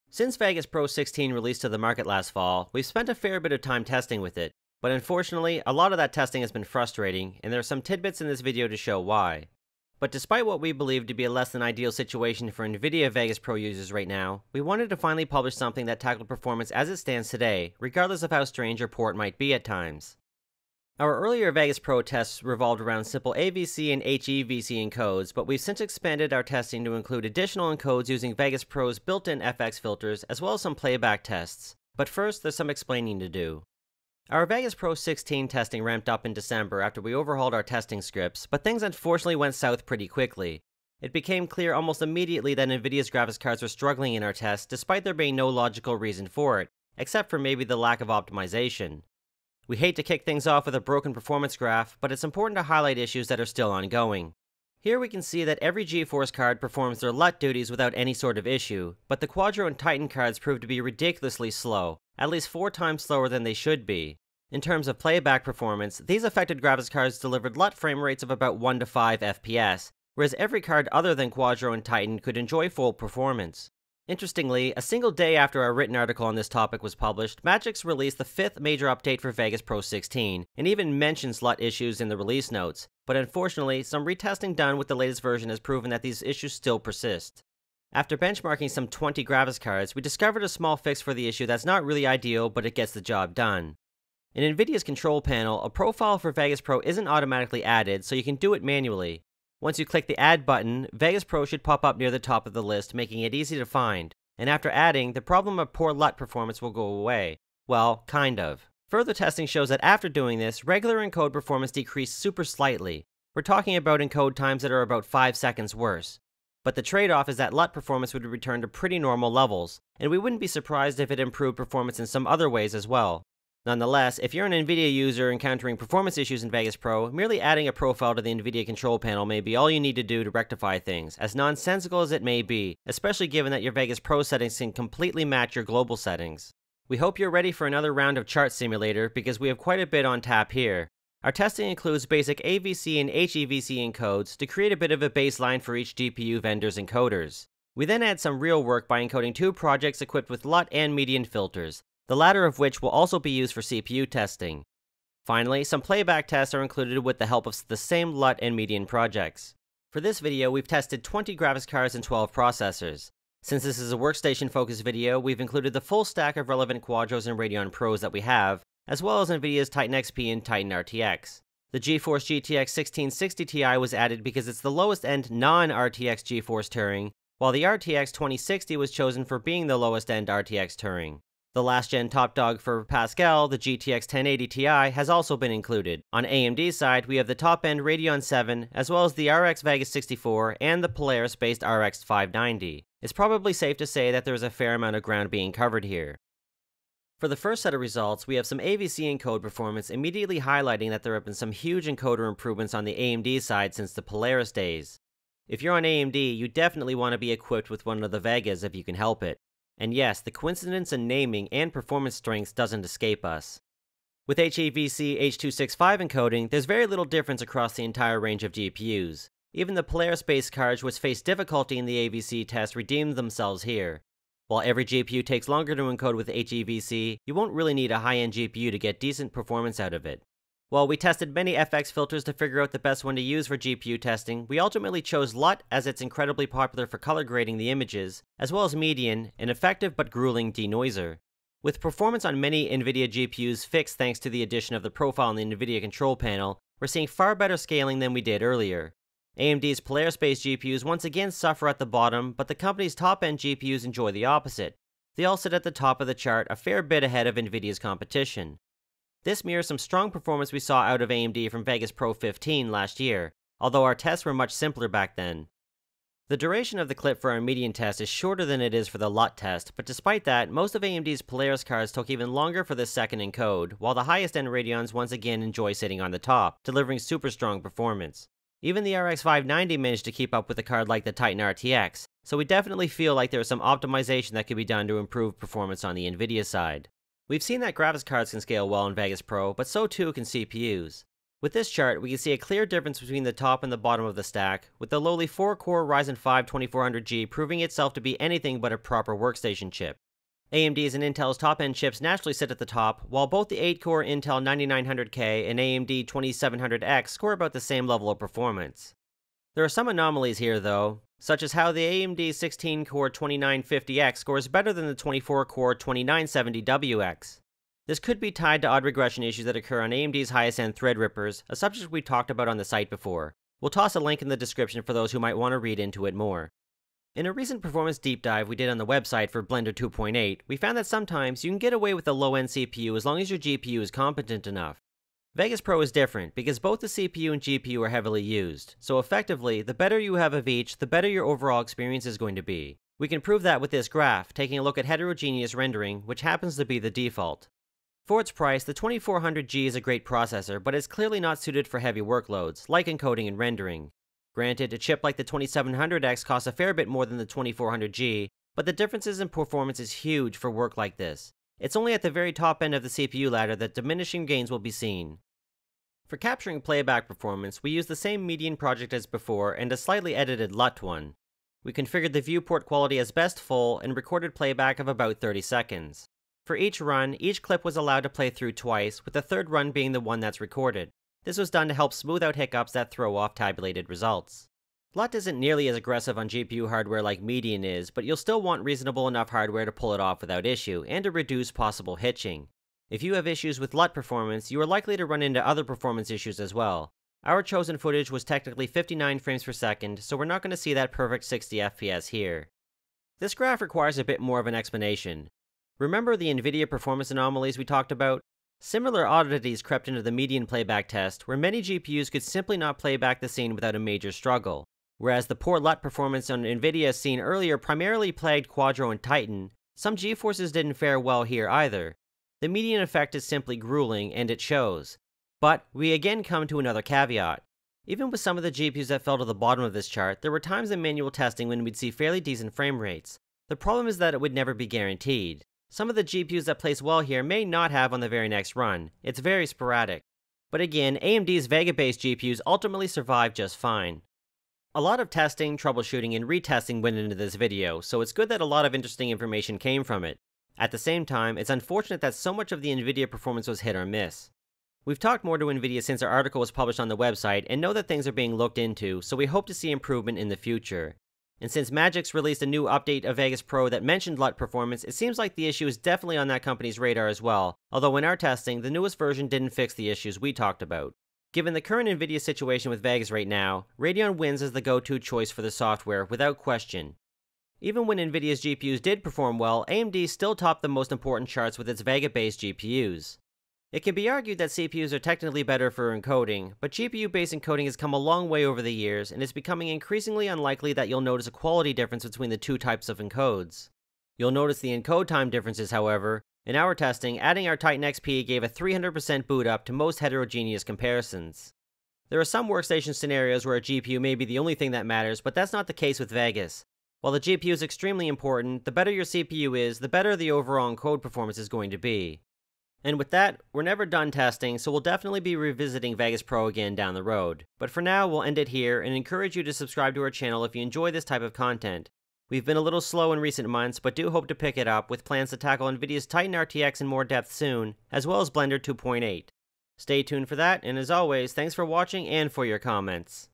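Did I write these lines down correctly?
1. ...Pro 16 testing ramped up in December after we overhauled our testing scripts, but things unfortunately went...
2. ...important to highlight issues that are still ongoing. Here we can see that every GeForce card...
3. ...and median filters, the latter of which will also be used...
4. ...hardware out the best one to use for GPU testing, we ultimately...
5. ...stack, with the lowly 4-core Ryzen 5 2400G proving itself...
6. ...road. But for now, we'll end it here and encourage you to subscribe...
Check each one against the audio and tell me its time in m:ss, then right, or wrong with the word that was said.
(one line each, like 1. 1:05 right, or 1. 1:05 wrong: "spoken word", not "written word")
1. 0:34 right
2. 0:52 right
3. 2:30 right
4. 3:52 wrong: "figure", not "hardware"
5. 4:54 right
6. 8:37 right.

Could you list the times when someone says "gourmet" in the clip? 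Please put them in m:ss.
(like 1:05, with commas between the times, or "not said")
not said.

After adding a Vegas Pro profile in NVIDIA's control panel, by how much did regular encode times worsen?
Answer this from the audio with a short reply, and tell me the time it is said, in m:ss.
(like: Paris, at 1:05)
5 seconds, at 1:54.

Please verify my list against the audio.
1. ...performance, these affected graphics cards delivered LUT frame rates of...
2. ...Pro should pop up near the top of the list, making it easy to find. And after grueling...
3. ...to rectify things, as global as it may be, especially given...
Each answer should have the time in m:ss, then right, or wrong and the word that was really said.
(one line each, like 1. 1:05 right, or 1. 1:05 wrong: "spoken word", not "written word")
1. 1:05 right
2. 1:41 wrong: "adding", not "grueling"
3. 2:10 wrong: "nonsensical", not "global".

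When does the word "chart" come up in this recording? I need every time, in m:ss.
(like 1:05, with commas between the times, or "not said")
2:18, 4:16, 4:51, 7:09, 8:01.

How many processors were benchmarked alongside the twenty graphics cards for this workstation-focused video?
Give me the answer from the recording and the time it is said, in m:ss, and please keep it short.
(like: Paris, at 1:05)
12, at 2:42.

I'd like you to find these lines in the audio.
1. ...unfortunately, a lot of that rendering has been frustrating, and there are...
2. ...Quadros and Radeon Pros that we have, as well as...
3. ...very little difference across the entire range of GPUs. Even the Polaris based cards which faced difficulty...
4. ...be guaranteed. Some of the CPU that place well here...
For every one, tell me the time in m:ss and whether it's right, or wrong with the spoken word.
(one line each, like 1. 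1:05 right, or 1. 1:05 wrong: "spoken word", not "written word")
1. 0:04 wrong: "testing", not "rendering"
2. 2:46 right
3. 3:36 right
4. 7:14 wrong: "GPUs", not "CPU".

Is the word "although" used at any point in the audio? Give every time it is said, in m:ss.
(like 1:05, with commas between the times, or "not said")
4:23, 7:47.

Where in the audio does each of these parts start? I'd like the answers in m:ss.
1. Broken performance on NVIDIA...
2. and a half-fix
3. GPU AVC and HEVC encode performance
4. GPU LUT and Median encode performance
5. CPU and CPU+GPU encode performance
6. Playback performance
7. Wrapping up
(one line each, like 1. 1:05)
1. 0:50
2. 1:30
3. 3:15
4. 3:50
5. 4:45
6. 6:05
7. 7:25.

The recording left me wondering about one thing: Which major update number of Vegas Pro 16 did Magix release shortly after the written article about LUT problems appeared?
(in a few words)
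fifth.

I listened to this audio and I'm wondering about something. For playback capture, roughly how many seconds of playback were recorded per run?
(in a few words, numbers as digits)
30 seconds.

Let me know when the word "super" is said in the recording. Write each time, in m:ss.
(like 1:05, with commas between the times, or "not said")
1:52, 4:36.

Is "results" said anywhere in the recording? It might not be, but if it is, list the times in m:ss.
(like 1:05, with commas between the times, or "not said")
3:17, 6:23.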